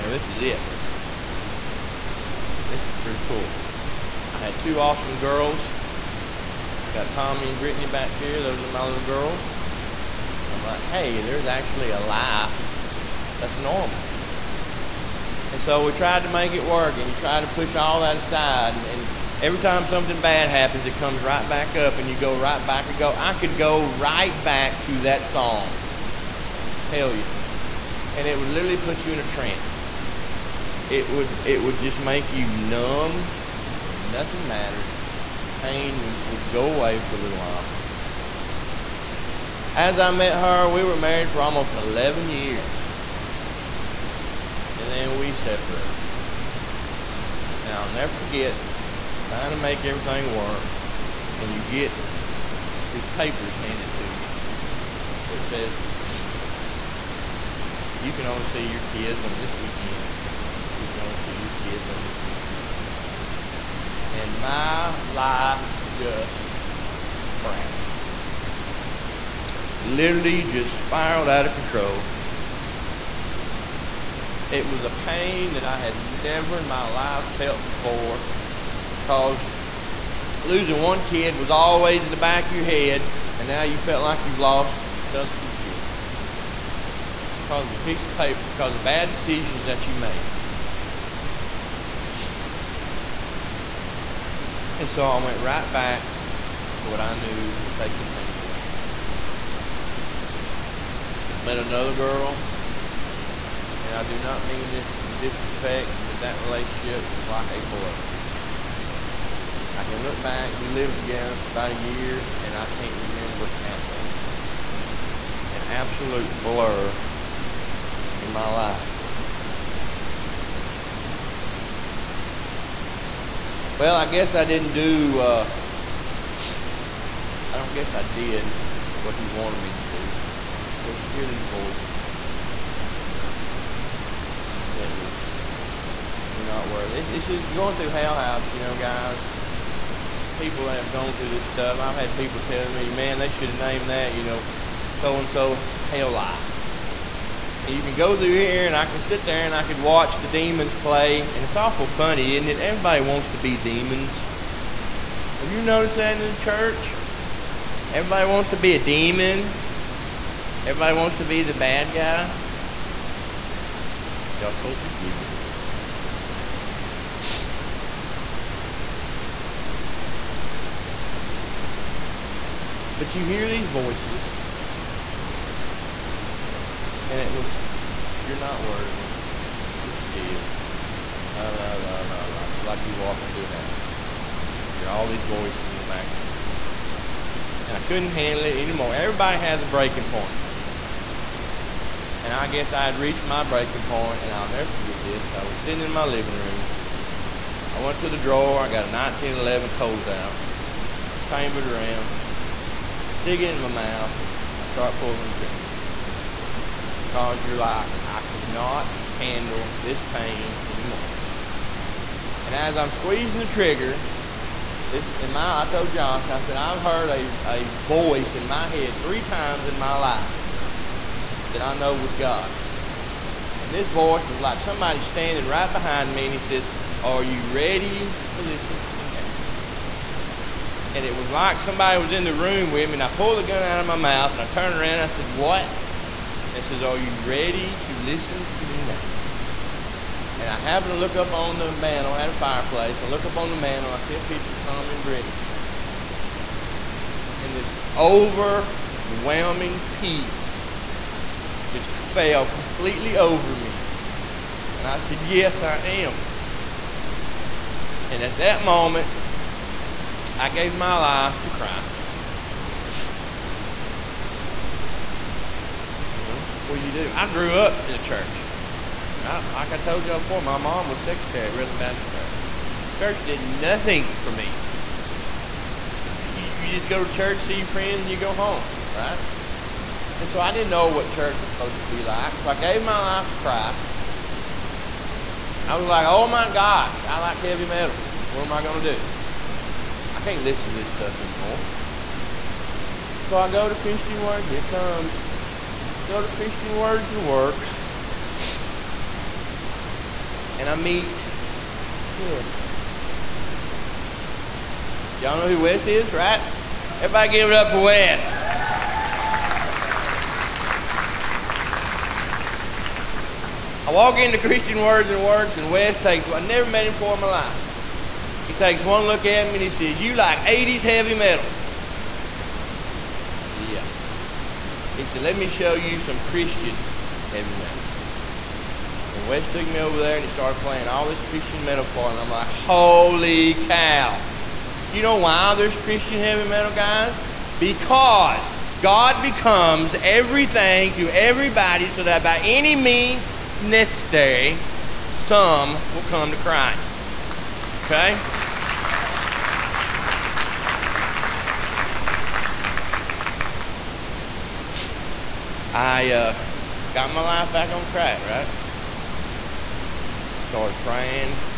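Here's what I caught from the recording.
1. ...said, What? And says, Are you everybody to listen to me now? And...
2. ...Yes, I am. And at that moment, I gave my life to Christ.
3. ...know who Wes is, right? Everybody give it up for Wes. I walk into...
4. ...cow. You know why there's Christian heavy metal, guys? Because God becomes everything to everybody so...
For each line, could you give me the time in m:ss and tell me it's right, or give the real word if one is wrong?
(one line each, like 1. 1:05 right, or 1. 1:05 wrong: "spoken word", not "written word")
1. 3:55 wrong: "ready", not "everybody"
2. 4:15 right
3. 5:05 right
4. 5:33 right.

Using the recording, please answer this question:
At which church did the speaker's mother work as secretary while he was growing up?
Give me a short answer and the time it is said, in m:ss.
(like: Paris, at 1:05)
Redland Baptist Church, at 4:31.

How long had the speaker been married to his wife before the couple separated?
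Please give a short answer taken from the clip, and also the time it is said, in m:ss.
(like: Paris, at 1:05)
almost 11 years, at 0:41.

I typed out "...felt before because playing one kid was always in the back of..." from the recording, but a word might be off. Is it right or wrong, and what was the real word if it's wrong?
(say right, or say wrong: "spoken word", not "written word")
wrong: "losing", not "playing".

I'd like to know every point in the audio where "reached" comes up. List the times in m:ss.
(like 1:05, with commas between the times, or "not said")
3:12.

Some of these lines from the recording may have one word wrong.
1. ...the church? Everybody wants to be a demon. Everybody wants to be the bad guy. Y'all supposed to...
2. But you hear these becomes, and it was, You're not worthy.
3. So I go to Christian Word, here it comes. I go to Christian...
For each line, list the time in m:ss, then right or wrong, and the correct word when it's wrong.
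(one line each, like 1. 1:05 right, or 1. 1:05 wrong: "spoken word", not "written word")
1. 2:36 right
2. 2:52 wrong: "voices", not "becomes"
3. 4:53 right.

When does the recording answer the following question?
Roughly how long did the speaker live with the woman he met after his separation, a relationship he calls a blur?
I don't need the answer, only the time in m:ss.
1:51.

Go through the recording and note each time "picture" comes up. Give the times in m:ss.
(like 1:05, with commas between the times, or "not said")
4:04.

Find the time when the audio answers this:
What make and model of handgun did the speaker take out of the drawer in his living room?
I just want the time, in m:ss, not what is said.
3:18.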